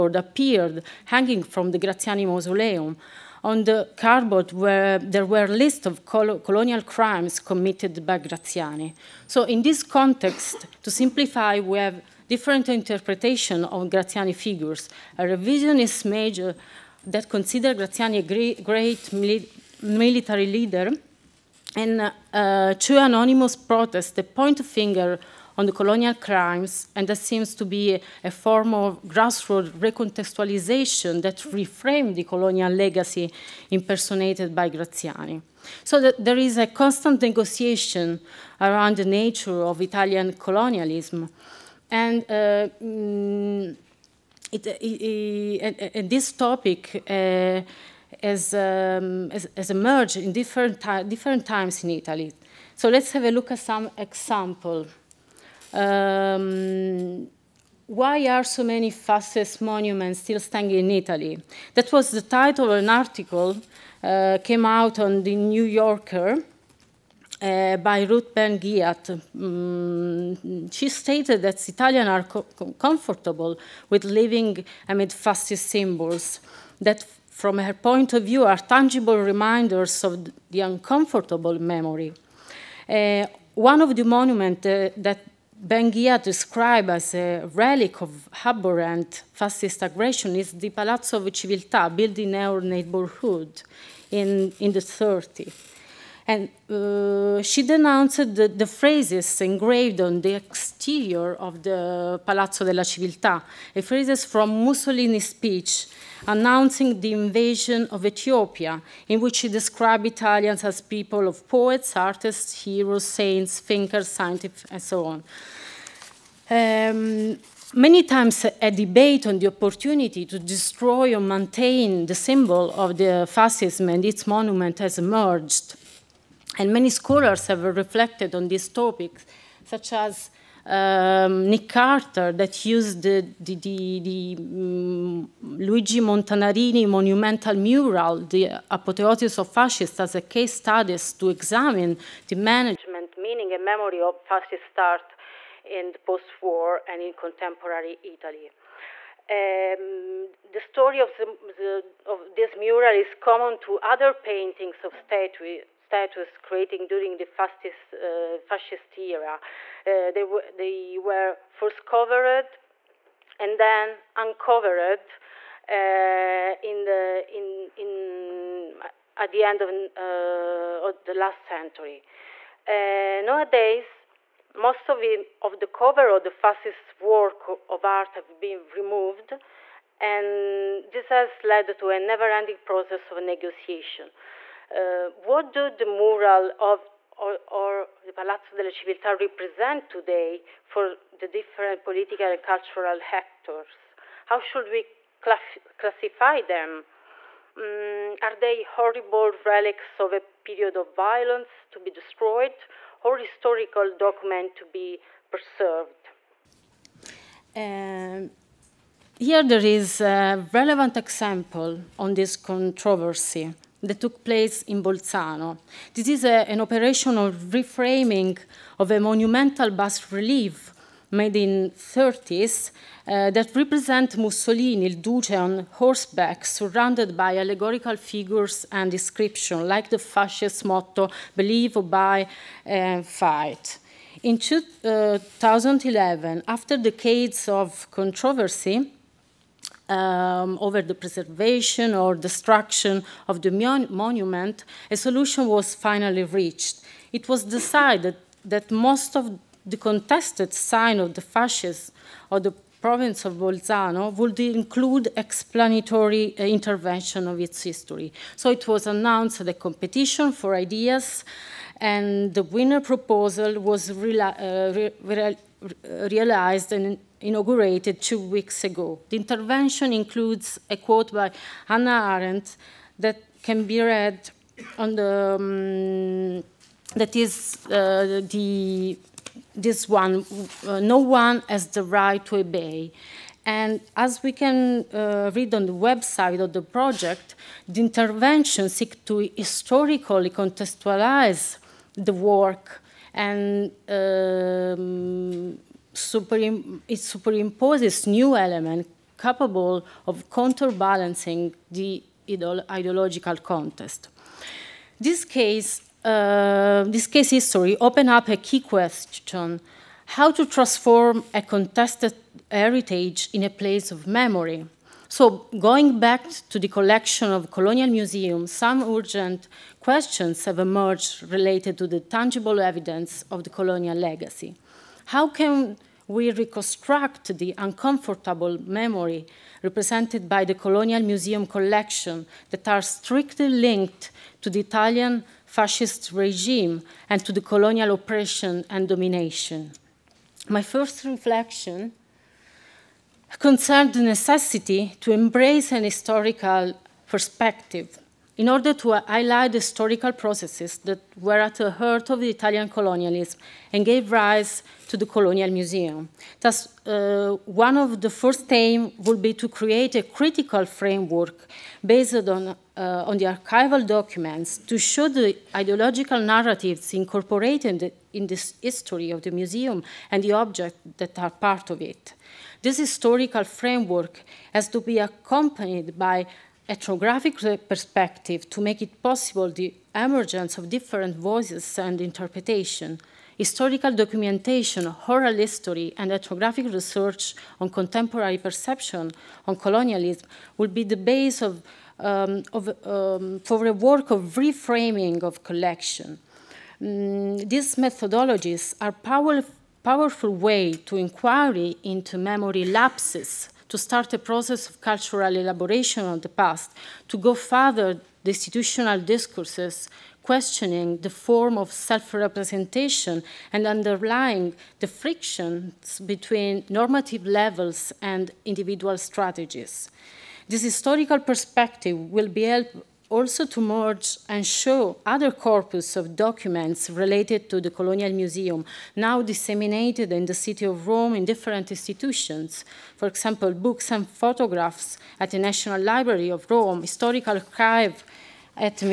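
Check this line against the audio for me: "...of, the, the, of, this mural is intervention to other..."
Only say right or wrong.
wrong.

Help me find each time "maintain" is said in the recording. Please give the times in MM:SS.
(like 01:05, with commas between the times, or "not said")
02:01.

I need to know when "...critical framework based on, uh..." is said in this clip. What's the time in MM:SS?
06:00.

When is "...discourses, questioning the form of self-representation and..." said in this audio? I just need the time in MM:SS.
06:49.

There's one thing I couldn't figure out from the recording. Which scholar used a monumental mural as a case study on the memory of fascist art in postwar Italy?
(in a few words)
Nick Carter.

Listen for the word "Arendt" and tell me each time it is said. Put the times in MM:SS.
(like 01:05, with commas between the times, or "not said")
04:32.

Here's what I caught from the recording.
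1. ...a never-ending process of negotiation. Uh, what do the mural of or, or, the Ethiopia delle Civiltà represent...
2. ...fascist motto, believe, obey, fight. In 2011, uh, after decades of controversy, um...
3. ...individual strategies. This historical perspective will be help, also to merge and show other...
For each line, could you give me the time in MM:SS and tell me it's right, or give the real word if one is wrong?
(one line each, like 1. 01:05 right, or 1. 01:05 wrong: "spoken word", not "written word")
1. 03:01 wrong: "Palazzo", not "Ethiopia"
2. 03:49 right
3. 06:58 right.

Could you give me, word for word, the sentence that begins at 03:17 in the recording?
Um, are they horrible relics of a period of violence to be destroyed, or historical document to be preserved.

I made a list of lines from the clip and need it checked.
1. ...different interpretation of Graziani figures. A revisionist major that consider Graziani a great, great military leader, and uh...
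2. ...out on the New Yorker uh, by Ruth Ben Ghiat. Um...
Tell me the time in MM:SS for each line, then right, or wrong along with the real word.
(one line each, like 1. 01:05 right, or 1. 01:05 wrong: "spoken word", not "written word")
1. 00:12 right
2. 01:04 right.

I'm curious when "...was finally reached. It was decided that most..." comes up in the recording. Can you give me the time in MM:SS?
04:05.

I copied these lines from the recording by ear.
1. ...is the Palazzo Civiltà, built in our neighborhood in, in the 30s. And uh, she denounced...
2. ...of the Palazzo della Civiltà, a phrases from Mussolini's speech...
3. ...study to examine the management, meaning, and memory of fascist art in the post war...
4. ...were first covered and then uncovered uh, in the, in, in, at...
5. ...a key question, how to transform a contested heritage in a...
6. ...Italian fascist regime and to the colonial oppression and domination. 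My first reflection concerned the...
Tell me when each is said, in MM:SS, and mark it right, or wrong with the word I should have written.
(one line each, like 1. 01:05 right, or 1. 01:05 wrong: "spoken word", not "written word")
1. 01:30 right
2. 01:41 right
3. 02:20 right
4. 02:40 right
5. 05:08 right
6. 05:34 right.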